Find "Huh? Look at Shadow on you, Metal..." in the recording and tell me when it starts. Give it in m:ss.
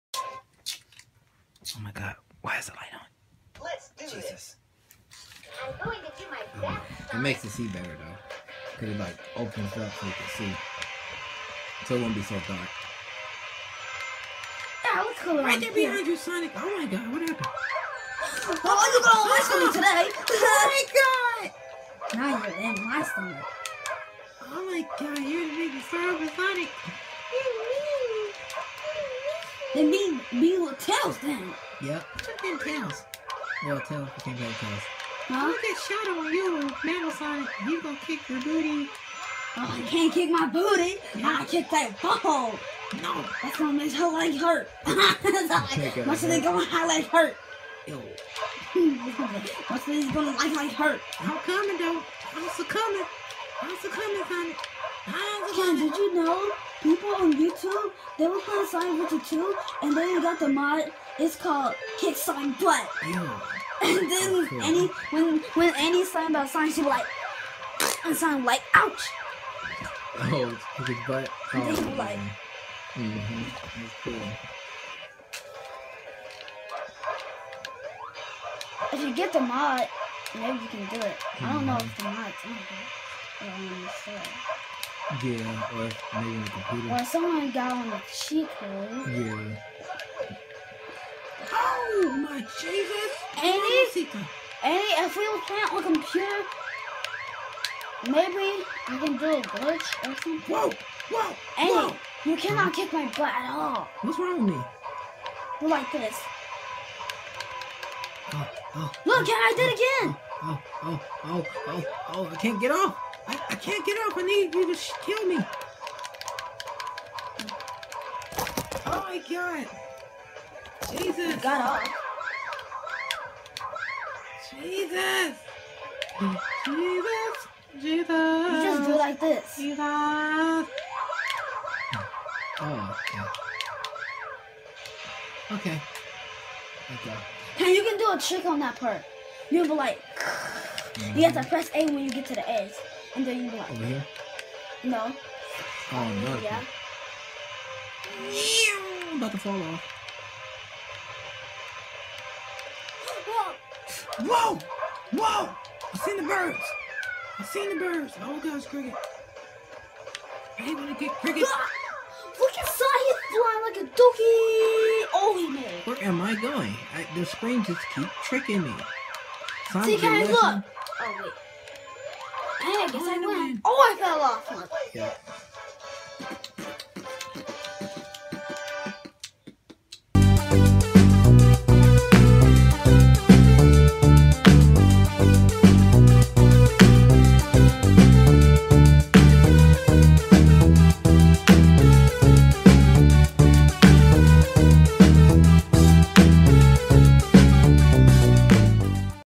0:35.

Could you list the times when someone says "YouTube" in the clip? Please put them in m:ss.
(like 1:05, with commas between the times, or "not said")
0:57.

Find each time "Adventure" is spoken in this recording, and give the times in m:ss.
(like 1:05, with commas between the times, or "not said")
0:59.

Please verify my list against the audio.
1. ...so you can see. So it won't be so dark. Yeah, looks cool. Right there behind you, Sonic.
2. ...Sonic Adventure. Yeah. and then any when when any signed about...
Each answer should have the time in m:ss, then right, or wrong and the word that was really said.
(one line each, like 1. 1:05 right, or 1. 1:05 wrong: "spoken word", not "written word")
1. 0:09 right
2. 1:02 wrong: "Butt", not "Adventure".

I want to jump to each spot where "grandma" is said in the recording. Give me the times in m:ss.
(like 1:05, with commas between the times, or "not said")
not said.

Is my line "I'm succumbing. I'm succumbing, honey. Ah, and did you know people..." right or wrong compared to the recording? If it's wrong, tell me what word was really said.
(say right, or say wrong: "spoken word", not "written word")
right.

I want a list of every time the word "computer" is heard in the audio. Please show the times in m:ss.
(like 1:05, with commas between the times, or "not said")
1:26, 1:35.